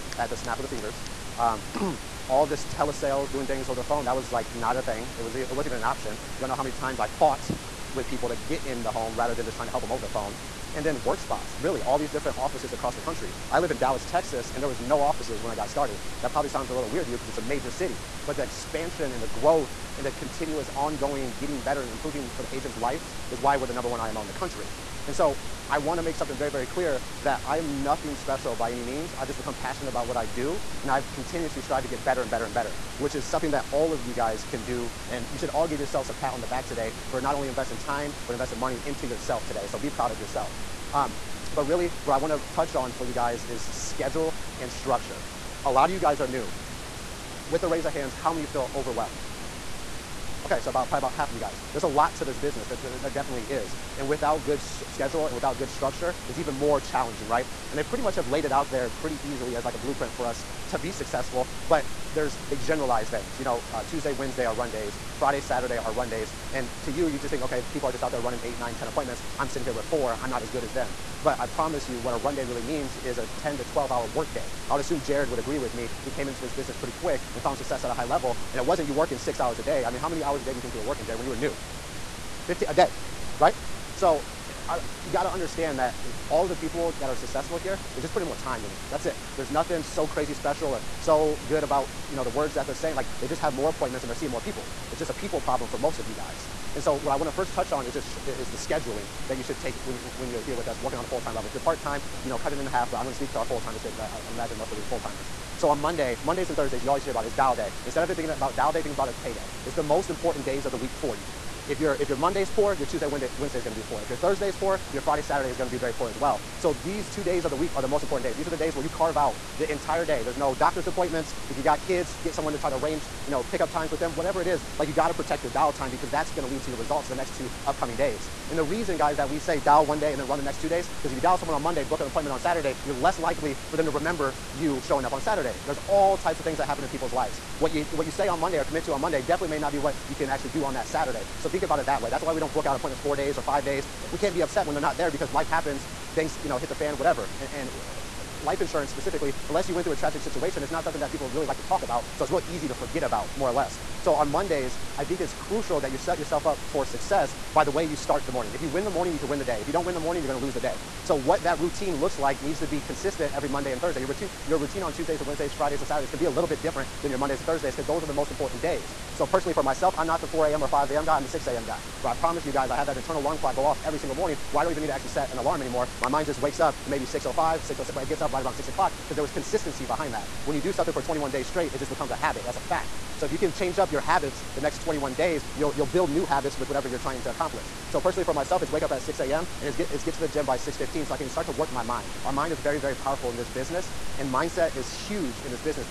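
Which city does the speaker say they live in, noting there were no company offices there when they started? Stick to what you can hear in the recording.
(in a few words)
Dallas, Texas.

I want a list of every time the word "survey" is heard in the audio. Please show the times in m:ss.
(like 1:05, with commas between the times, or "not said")
not said.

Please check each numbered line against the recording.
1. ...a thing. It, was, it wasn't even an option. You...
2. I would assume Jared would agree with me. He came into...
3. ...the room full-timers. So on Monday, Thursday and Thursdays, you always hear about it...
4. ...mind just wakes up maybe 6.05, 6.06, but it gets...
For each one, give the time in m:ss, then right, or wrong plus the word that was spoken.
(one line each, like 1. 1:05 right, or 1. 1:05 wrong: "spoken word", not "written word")
1. 0:04 right
2. 1:14 right
3. 1:44 wrong: "Mondays", not "Thursday"
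4. 2:56 right.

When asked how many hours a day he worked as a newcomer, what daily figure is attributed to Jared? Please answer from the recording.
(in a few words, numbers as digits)
15.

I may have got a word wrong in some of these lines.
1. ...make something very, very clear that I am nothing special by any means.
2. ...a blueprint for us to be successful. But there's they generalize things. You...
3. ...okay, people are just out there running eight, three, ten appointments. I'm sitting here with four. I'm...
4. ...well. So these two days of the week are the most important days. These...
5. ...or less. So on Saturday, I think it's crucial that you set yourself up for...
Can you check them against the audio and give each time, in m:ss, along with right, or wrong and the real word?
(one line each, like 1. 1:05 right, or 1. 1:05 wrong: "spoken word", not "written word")
1. 0:26 right
2. 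0:59 right
3. 1:07 wrong: "nine", not "three"
4. 1:56 right
5. 2:33 wrong: "Mondays", not "Saturday".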